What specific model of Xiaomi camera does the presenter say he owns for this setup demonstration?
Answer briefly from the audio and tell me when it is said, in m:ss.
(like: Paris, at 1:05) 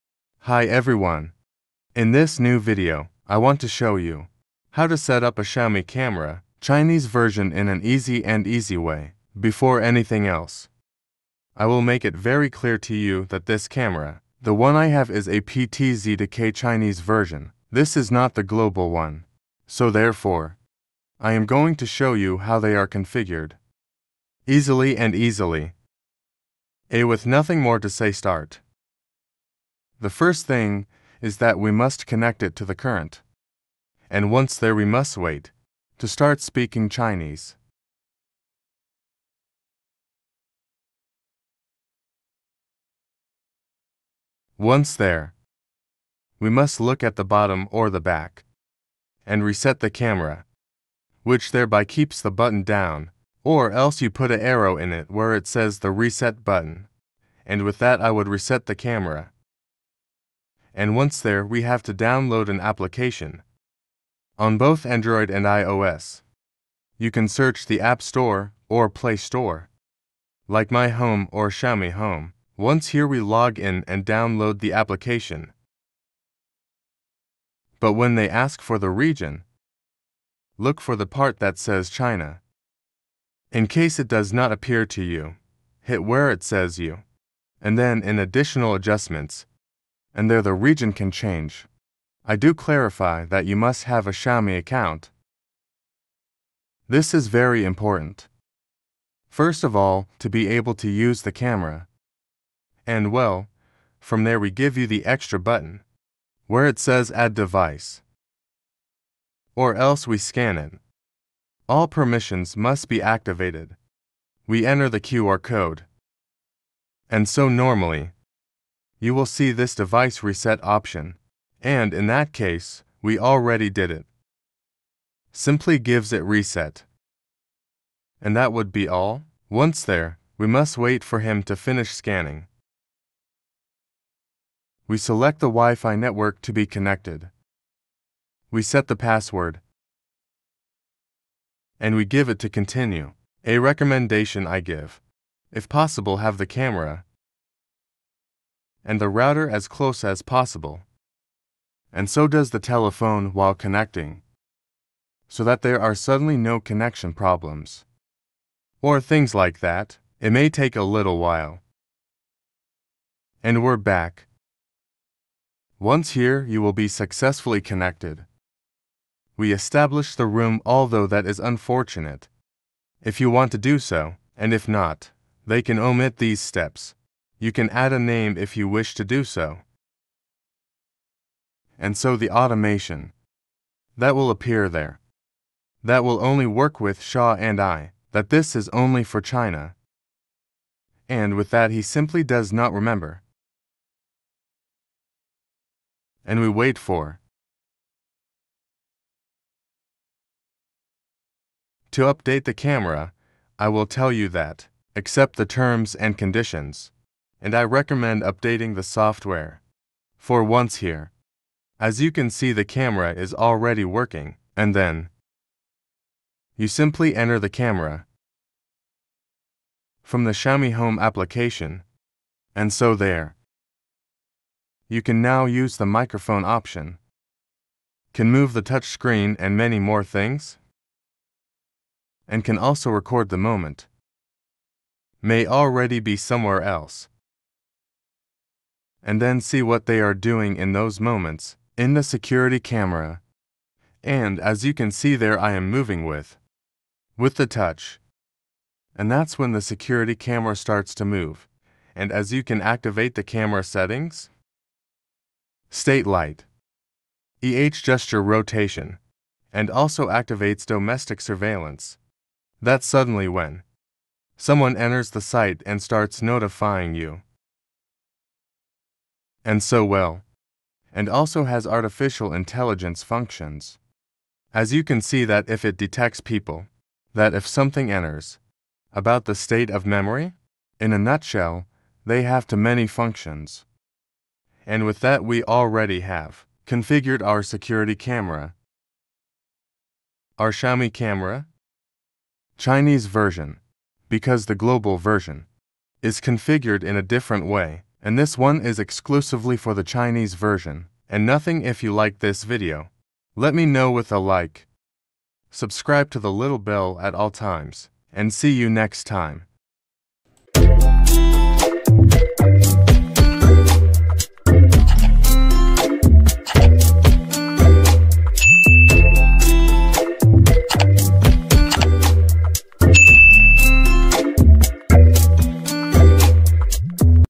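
PTZ K, at 0:15.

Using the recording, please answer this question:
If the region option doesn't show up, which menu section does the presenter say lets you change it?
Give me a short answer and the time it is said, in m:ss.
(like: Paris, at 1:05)
additional adjustments, at 1:28.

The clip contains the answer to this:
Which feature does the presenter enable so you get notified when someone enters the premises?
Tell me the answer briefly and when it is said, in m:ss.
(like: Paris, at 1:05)
domestic surveillance, at 4:20.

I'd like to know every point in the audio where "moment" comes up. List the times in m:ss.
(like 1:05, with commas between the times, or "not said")
3:53, 4:00.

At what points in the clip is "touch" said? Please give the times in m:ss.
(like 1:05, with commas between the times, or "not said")
3:48, 4:07.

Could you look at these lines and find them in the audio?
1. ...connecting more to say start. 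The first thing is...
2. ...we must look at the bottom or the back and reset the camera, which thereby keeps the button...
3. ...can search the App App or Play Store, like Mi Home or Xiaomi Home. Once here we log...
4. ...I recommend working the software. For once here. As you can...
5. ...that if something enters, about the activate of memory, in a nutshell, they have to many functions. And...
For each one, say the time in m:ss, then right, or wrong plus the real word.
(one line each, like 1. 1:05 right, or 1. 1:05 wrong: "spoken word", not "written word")
1. 0:27 wrong: "nothing", not "connecting"
2. 0:46 right
3. 1:07 wrong: "Store", not "App"
4. 3:27 wrong: "updating", not "working"
5. 4:37 wrong: "state", not "activate".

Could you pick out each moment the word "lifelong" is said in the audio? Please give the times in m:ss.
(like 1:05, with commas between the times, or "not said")
not said.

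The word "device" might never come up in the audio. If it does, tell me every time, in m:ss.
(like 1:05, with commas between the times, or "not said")
1:47, 1:59.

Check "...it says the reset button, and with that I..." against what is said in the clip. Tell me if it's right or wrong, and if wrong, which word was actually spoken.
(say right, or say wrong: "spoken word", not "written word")
right.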